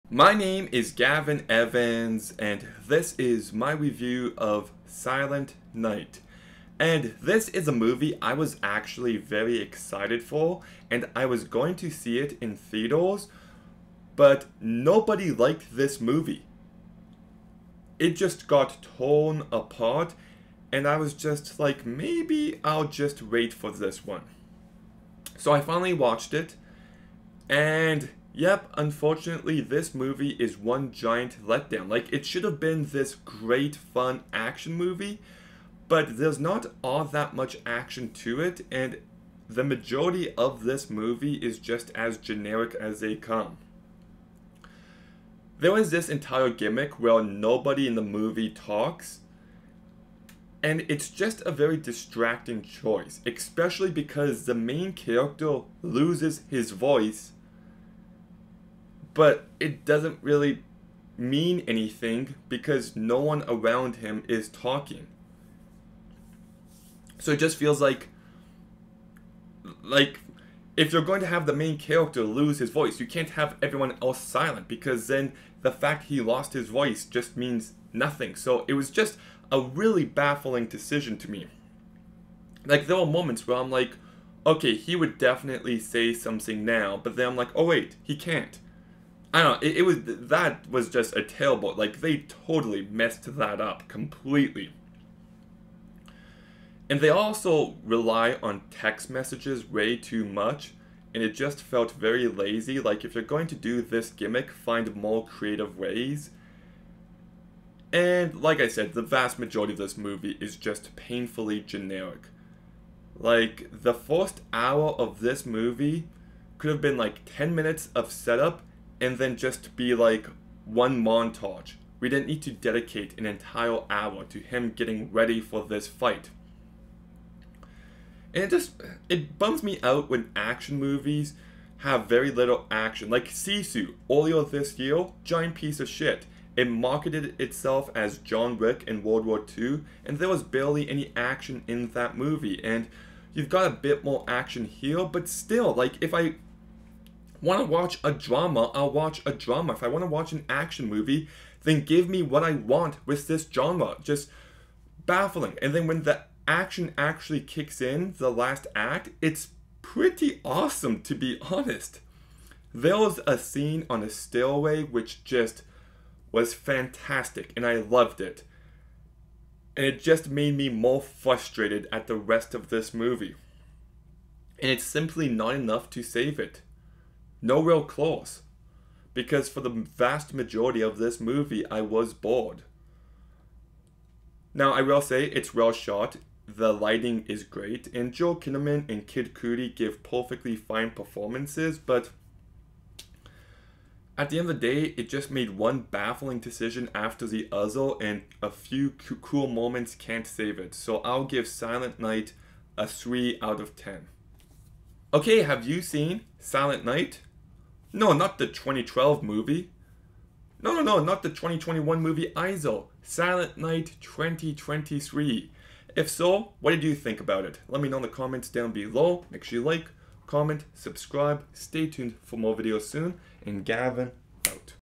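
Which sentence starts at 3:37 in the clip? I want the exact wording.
Let me know in the comments down below.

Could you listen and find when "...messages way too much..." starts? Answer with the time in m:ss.
1:39.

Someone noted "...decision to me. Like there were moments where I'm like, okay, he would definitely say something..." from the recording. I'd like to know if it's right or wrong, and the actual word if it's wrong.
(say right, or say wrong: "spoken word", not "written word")
right.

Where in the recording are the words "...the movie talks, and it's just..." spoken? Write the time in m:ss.
0:47.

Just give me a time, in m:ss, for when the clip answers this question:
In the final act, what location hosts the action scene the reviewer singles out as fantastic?
2:44.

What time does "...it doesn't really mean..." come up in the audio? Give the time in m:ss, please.
0:59.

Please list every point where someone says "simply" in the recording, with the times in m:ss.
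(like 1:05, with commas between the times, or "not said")
2:54.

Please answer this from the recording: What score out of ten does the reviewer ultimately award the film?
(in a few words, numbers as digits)
3.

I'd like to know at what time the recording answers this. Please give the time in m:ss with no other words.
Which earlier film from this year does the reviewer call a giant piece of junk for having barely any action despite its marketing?
2:13.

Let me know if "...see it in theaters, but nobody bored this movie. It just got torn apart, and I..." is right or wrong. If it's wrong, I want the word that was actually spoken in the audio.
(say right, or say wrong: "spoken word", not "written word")
wrong: "liked", not "bored".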